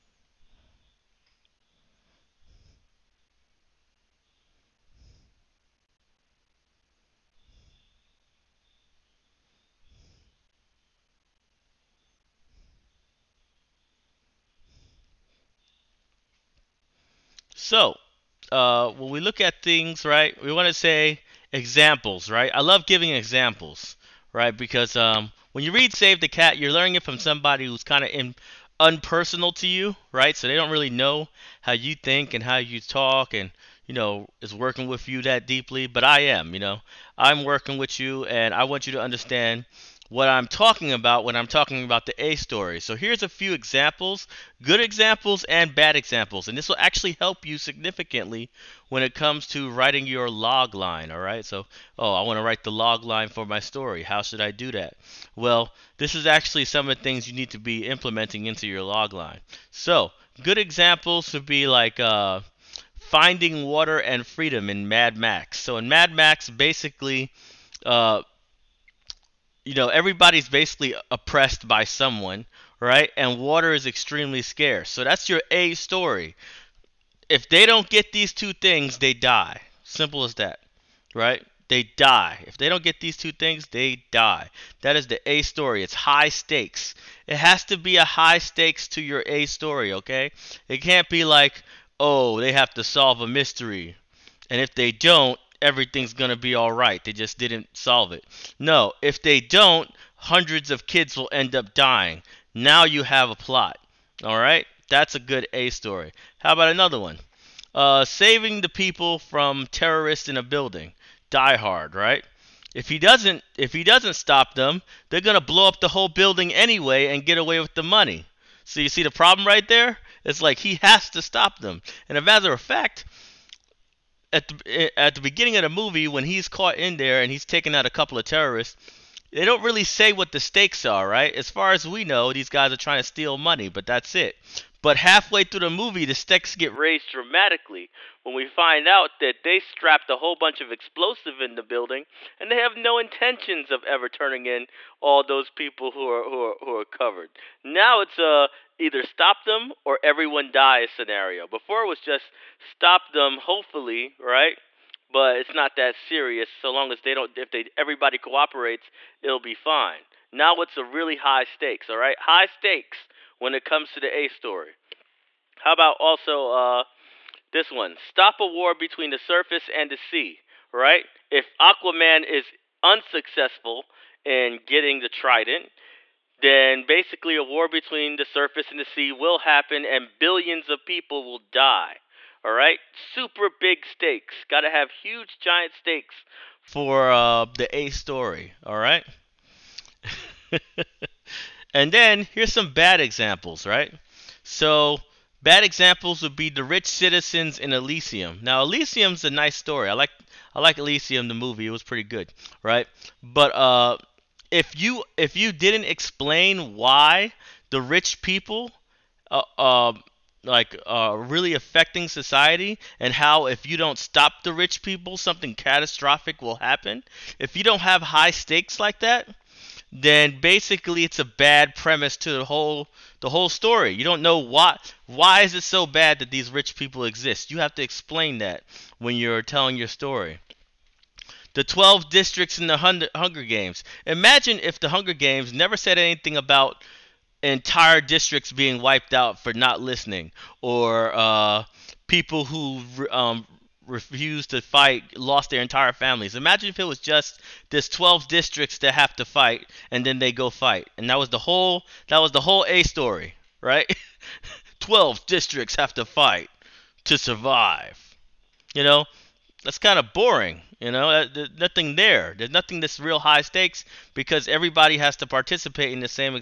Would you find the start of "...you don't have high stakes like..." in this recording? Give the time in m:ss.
3:37.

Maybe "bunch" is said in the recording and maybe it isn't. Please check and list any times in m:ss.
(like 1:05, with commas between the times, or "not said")
2:20.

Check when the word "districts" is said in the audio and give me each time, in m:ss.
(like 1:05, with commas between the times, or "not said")
3:52, 3:58, 4:08, 4:15.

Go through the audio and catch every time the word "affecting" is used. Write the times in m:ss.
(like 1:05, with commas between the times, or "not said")
3:31.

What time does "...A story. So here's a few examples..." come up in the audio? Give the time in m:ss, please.
0:42.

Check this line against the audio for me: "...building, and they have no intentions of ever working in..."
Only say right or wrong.
wrong.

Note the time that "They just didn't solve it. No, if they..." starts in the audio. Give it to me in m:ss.
1:37.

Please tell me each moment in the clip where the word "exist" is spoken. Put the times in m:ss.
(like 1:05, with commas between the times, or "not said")
3:47.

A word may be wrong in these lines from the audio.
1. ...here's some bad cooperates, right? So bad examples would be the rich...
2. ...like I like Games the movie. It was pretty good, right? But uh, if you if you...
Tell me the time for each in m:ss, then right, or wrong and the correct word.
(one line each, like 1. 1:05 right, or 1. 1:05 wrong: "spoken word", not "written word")
1. 3:12 wrong: "examples", not "cooperates"
2. 3:19 wrong: "Elysium", not "Games".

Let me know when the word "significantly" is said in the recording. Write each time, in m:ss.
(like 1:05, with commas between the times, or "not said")
0:47.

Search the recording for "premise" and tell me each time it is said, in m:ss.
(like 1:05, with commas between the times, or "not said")
3:41.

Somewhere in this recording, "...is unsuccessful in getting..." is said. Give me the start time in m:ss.
2:52.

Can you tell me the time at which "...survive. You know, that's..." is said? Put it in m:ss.
4:17.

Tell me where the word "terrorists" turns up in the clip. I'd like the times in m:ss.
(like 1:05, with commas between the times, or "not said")
1:49, 2:08.